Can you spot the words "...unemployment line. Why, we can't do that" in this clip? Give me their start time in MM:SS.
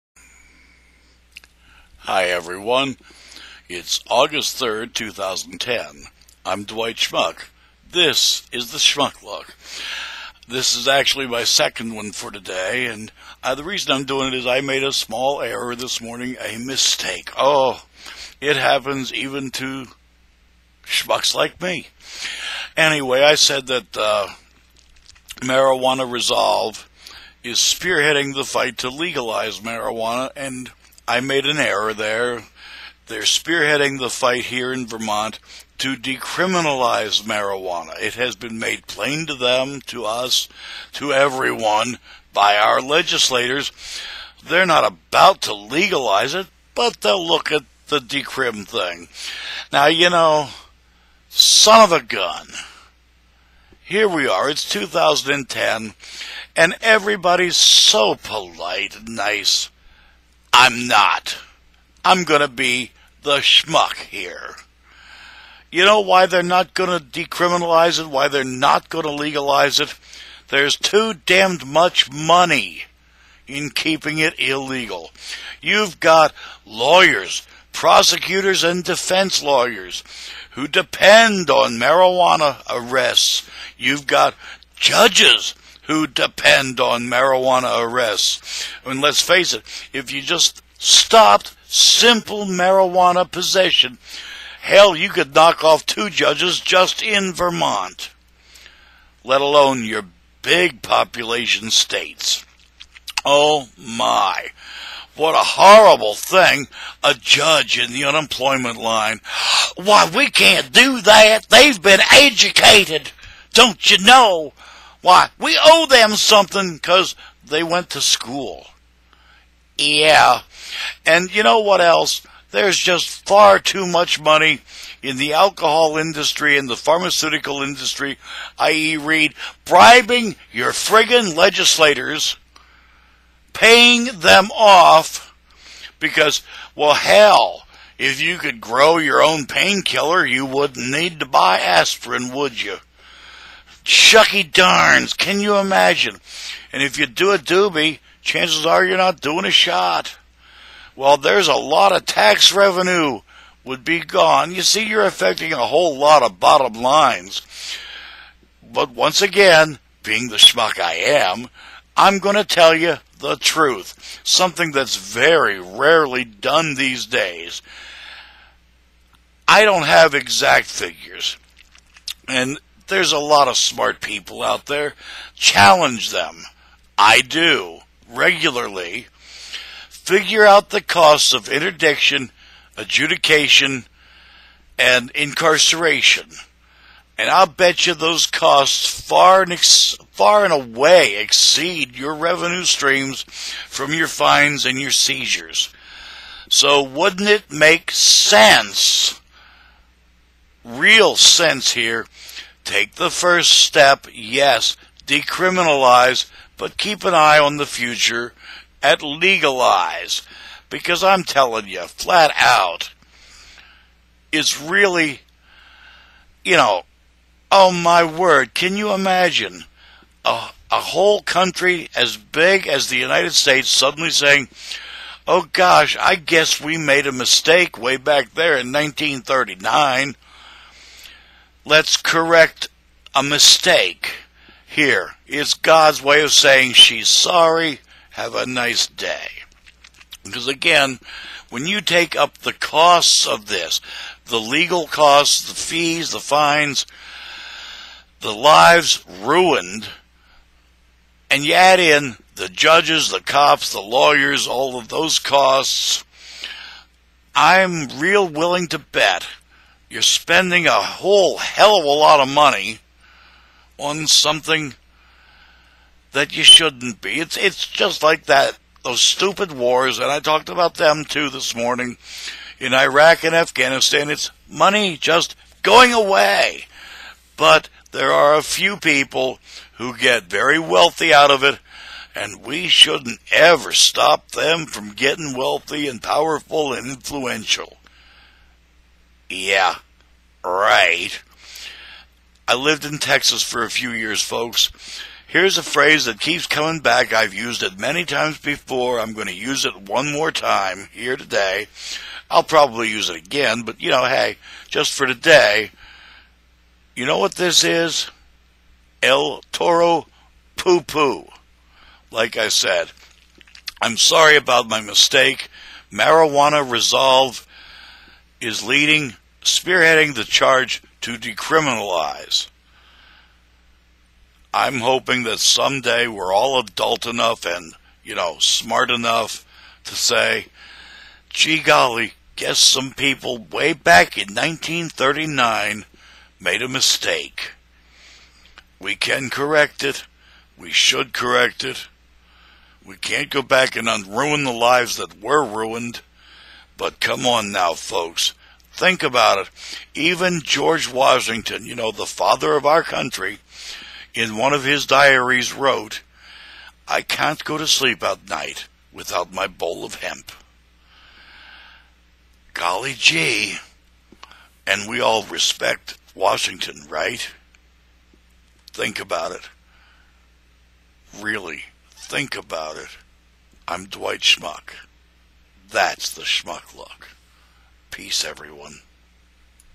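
01:48.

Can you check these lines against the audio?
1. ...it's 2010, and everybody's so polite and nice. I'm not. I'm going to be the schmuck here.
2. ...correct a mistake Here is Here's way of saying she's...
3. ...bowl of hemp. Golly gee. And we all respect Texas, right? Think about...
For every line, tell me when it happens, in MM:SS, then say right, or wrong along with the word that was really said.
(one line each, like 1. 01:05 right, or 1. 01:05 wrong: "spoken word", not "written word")
1. 00:54 right
2. 03:51 wrong: "God", not "Here"
3. 05:59 wrong: "Washington", not "Texas".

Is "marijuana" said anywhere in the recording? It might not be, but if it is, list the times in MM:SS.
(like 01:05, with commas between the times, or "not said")
00:25, 00:29, 00:37, 01:21, 01:27, 01:32, 05:15.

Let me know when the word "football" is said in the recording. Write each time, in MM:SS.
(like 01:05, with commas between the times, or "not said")
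not said.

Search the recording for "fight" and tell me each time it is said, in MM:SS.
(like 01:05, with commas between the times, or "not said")
00:28, 00:34.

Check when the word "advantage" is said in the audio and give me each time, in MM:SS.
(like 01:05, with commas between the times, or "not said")
not said.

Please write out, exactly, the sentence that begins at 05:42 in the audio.
We can't go back and unruin the lives that were ruined.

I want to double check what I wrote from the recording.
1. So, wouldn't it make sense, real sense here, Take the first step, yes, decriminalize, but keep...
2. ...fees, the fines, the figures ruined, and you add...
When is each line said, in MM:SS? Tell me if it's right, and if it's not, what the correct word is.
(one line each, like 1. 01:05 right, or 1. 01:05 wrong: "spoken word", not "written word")
1. 03:16 right
2. 04:05 wrong: "lives", not "figures".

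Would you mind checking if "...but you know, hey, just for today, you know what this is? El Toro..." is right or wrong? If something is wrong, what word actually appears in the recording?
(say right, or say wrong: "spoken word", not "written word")
right.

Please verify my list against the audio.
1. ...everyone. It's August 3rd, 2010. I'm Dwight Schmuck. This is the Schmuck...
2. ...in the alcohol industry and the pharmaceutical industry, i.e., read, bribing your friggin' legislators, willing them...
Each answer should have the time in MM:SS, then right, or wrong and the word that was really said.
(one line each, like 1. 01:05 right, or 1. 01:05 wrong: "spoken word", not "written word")
1. 00:02 right
2. 02:05 wrong: "paying", not "willing".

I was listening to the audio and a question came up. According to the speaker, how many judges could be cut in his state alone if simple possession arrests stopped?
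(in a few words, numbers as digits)
2.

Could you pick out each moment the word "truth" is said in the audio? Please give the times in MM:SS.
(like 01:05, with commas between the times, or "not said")
02:43.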